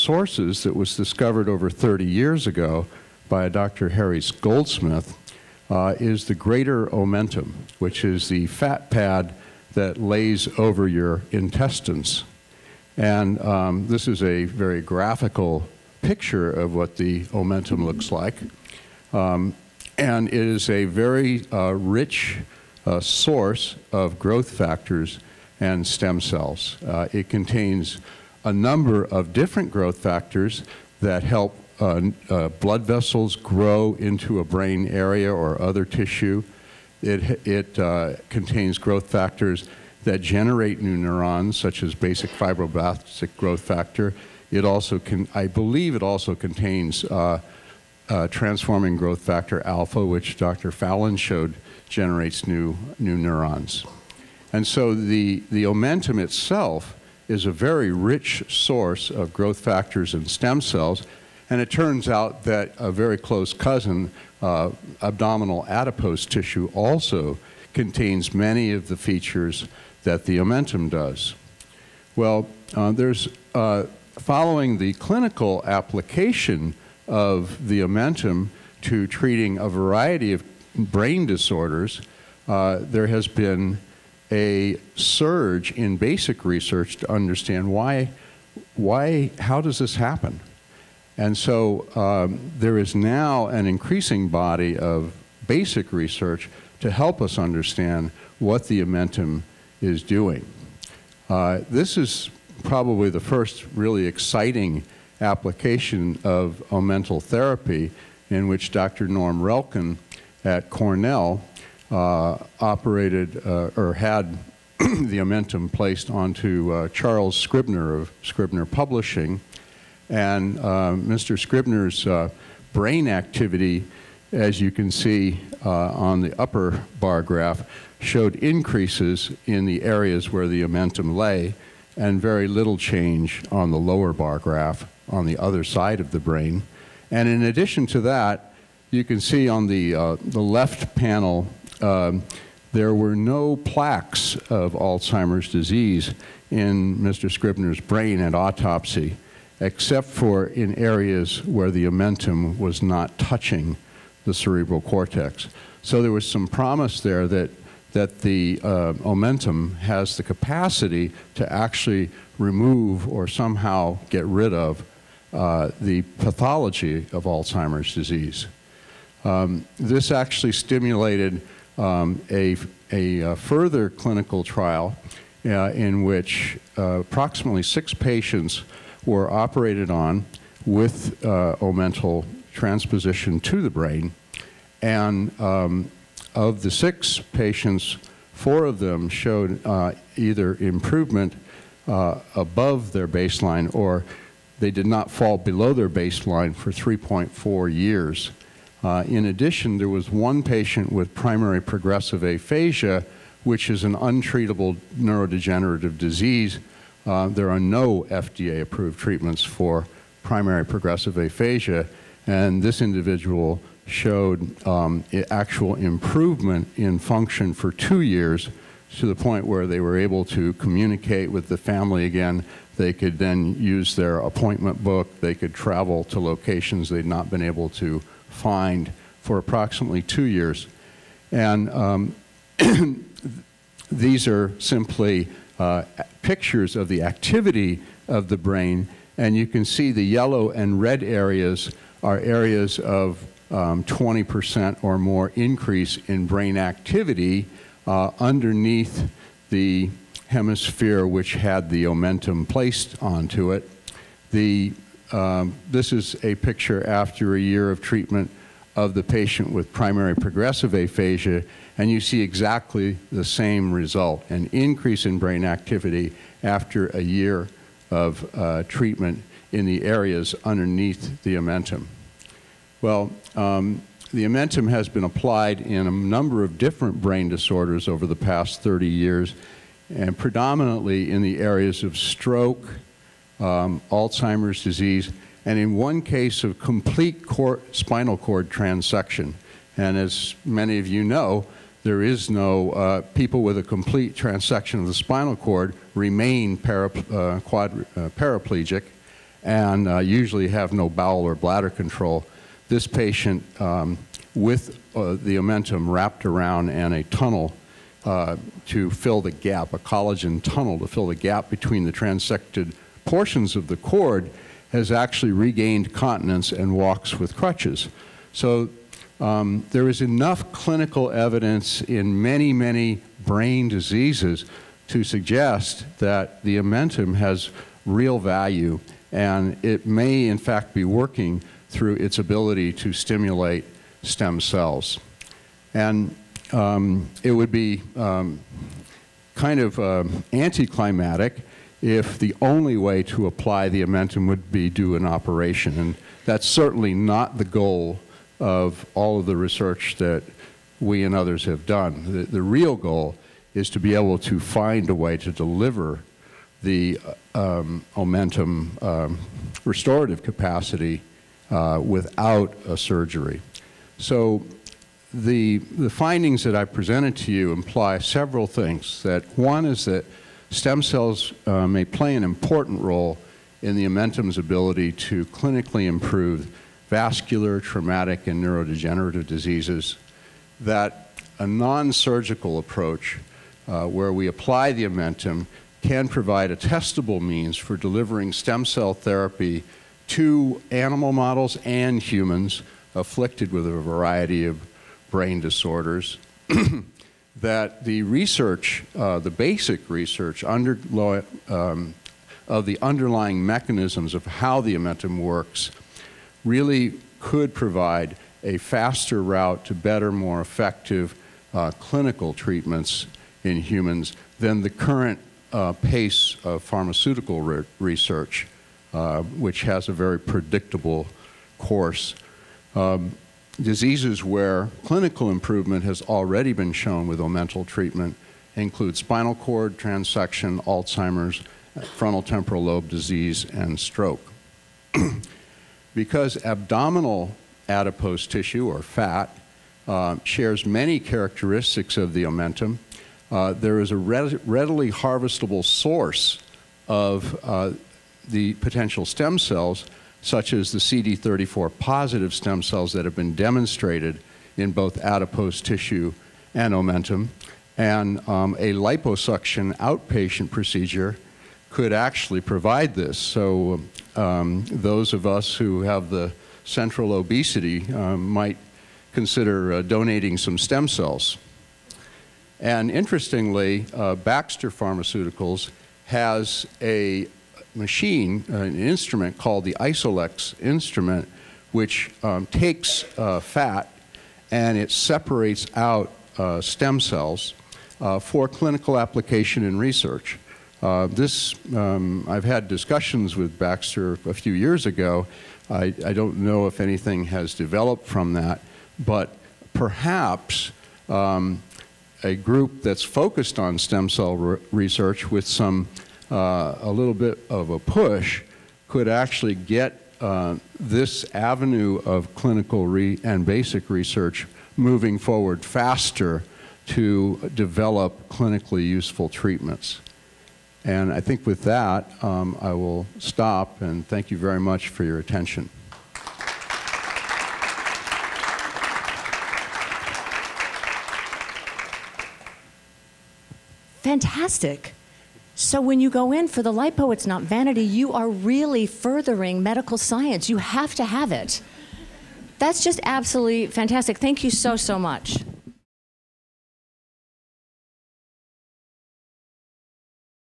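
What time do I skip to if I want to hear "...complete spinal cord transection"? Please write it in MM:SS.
04:46.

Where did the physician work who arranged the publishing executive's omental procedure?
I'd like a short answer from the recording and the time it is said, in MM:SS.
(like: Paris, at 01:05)
Cornell, at 01:50.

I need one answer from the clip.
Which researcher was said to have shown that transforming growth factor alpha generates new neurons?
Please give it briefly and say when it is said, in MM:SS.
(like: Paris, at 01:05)
Dr. Fallon, at 00:50.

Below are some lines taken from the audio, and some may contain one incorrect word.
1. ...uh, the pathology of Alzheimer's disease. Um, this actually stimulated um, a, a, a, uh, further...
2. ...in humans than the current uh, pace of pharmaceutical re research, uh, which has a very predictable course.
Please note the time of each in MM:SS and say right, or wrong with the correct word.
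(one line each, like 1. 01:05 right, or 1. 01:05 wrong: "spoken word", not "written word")
1. 02:45 right
2. 06:53 right.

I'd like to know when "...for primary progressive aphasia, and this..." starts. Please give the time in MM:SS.
03:29.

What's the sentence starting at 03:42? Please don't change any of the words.
They could then use their appointment book.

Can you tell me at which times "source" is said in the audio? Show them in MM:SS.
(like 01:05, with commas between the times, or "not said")
00:23, 00:58, 07:25.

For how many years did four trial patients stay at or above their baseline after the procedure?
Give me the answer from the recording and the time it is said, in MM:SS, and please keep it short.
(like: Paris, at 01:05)
3.4, at 03:16.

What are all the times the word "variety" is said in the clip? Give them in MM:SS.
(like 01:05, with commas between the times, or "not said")
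01:19, 06:33.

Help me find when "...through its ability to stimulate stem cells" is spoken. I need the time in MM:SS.
05:31.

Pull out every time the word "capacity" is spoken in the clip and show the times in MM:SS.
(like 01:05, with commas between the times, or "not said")
02:40, 06:00.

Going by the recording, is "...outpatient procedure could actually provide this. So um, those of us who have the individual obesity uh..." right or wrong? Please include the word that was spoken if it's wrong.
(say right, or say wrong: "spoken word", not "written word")
wrong: "central", not "individual".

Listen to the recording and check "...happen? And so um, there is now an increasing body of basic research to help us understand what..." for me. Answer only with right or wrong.
right.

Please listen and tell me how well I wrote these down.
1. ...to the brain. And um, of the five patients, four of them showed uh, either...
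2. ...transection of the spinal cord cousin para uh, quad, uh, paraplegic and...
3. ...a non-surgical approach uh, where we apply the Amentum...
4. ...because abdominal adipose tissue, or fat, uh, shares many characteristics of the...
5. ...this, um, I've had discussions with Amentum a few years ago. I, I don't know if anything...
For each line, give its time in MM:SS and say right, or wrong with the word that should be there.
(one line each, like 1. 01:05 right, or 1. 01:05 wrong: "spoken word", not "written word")
1. 03:03 wrong: "six", not "five"
2. 04:54 wrong: "remain", not "cousin"
3. 06:21 right
4. 07:15 right
5. 08:11 wrong: "Baxter", not "Amentum".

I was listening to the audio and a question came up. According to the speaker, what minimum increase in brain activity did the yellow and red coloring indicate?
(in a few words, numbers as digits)
20%.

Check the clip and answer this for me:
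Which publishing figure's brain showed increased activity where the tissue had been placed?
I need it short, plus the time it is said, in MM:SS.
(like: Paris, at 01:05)
Charles Scribner, at 01:56.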